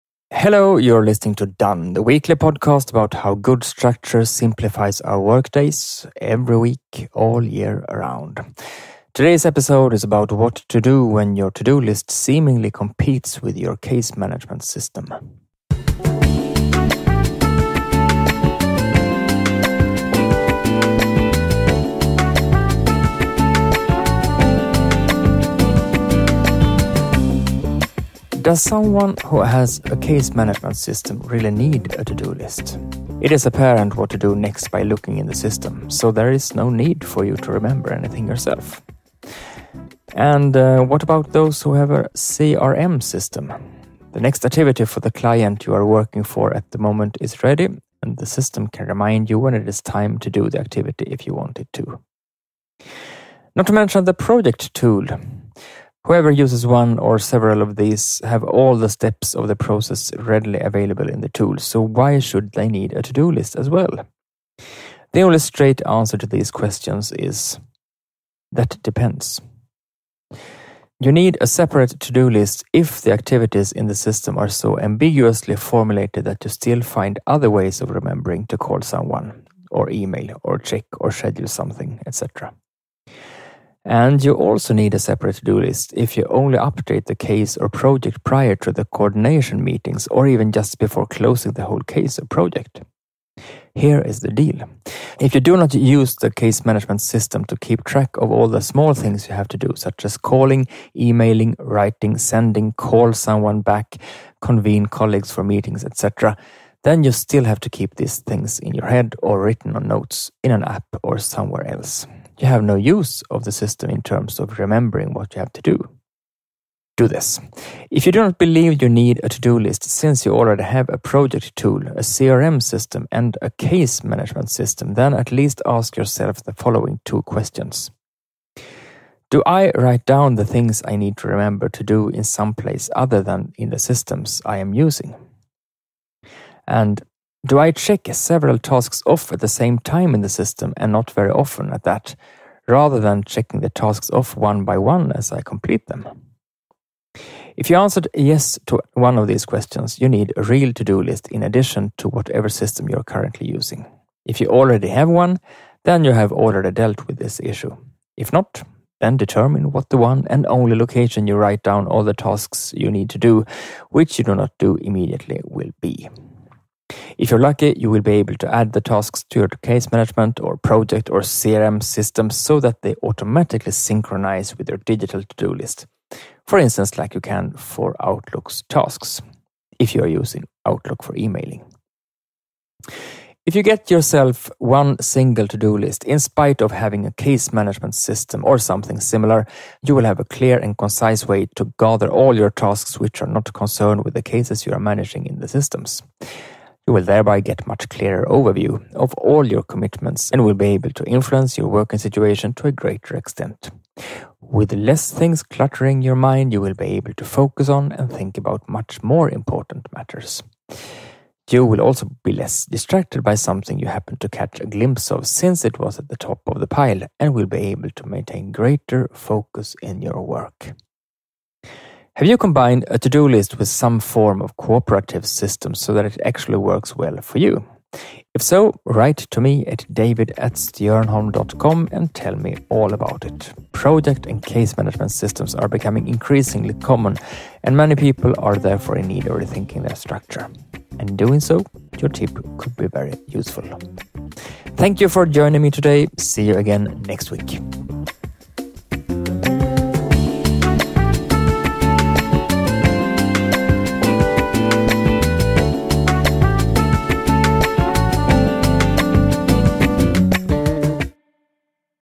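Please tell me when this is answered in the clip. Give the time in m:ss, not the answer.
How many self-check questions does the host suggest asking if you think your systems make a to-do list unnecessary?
2:07.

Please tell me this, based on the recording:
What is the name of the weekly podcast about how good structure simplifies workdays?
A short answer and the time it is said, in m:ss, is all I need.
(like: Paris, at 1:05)
Done, at 0:01.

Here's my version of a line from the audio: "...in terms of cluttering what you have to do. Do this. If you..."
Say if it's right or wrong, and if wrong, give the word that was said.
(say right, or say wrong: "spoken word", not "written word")
wrong: "remembering", not "cluttering".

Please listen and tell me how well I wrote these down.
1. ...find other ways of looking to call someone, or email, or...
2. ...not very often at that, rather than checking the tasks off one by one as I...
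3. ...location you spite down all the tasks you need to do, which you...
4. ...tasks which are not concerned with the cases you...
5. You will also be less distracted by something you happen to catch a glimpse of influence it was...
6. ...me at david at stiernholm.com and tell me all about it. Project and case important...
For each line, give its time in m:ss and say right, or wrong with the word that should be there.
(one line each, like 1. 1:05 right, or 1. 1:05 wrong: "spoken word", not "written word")
1. 1:16 wrong: "remembering", not "looking"
2. 2:20 right
3. 2:40 wrong: "write", not "spite"
4. 3:12 right
5. 3:31 wrong: "since", not "influence"
6. 3:49 wrong: "management", not "important".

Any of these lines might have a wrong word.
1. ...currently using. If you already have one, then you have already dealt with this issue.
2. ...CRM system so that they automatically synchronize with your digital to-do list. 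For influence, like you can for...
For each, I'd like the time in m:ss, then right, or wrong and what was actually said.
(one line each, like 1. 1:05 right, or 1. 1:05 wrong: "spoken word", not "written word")
1. 2:33 right
2. 2:51 wrong: "instance", not "influence".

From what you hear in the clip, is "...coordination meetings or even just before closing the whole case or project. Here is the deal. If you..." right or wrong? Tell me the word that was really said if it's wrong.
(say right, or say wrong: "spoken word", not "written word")
right.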